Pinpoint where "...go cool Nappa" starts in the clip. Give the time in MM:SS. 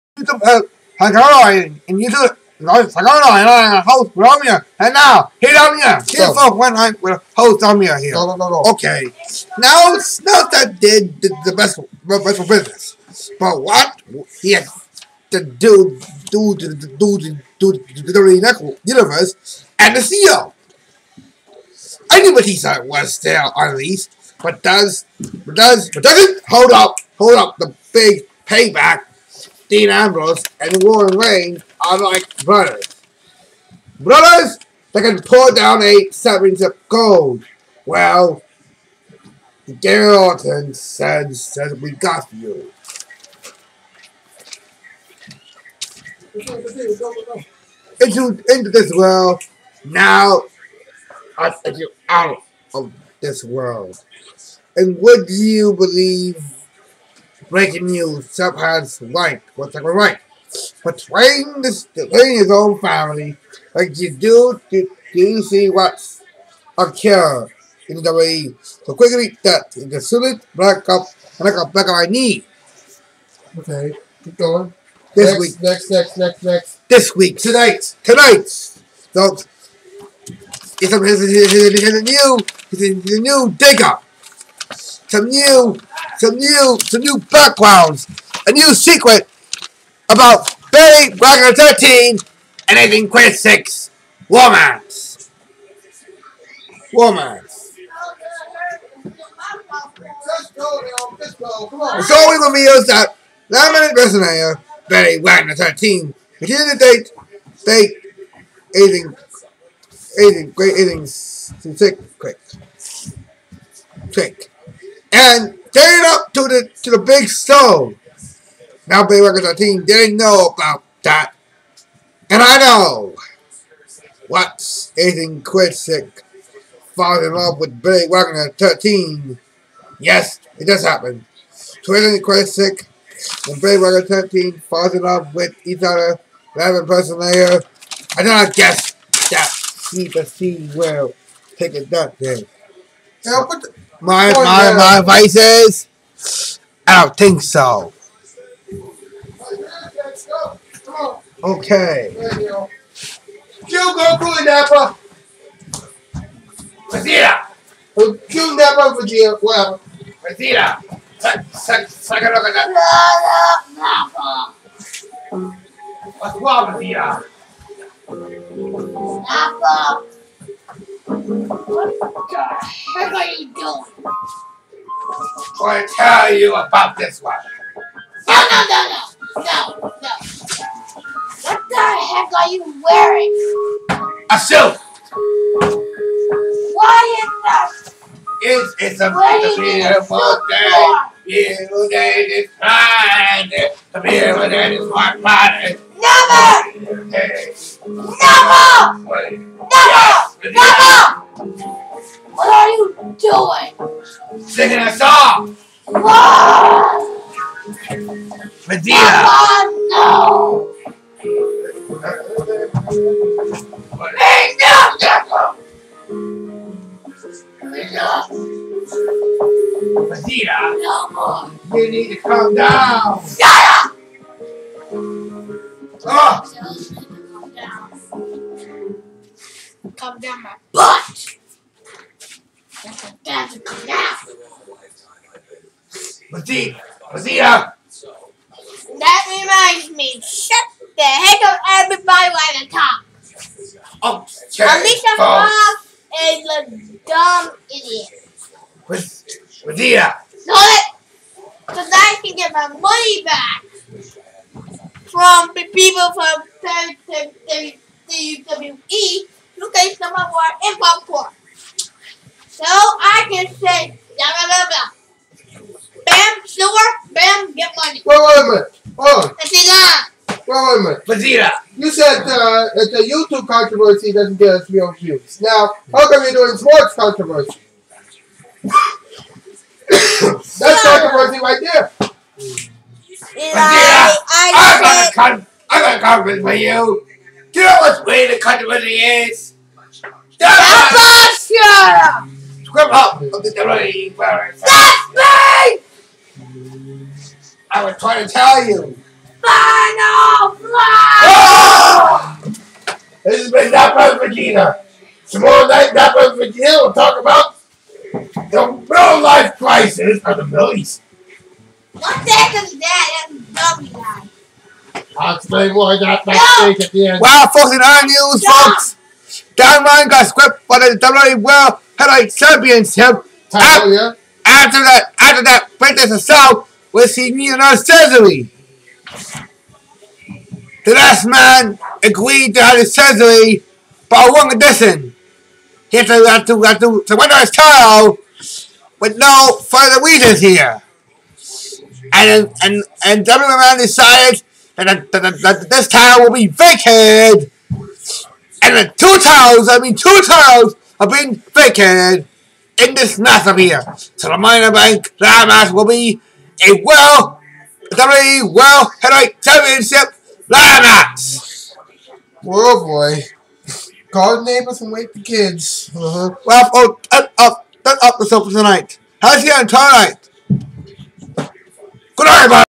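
02:33.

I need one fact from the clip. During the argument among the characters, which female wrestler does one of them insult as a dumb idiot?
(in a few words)
Alicia Fox.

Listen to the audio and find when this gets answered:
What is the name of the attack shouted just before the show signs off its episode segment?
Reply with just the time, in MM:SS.
04:59.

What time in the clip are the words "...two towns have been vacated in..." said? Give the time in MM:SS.
05:49.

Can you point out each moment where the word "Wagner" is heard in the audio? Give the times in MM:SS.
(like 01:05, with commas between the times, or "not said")
01:45, 02:08, 02:13.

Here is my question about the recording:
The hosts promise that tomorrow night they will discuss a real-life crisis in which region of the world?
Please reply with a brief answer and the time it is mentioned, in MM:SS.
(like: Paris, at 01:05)
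Middle East, at 05:10.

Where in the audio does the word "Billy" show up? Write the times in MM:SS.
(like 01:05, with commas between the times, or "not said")
01:44, 02:07, 02:13.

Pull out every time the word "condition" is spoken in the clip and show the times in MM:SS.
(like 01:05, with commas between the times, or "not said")
05:34.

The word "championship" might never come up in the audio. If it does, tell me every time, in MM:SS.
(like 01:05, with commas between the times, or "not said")
05:22, 05:59.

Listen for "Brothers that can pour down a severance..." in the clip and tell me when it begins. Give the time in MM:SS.
00:34.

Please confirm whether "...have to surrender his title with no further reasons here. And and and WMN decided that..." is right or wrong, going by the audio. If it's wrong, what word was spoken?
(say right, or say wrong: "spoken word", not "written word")
right.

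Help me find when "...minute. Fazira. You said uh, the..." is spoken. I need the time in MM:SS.
04:30.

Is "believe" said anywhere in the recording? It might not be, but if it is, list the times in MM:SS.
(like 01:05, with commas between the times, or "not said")
00:55.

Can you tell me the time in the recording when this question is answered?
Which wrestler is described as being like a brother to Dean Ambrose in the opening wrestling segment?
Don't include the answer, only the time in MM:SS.
00:30.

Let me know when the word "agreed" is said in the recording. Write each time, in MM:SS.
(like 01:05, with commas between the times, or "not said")
05:32.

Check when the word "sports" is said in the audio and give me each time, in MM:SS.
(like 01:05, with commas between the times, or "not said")
04:36.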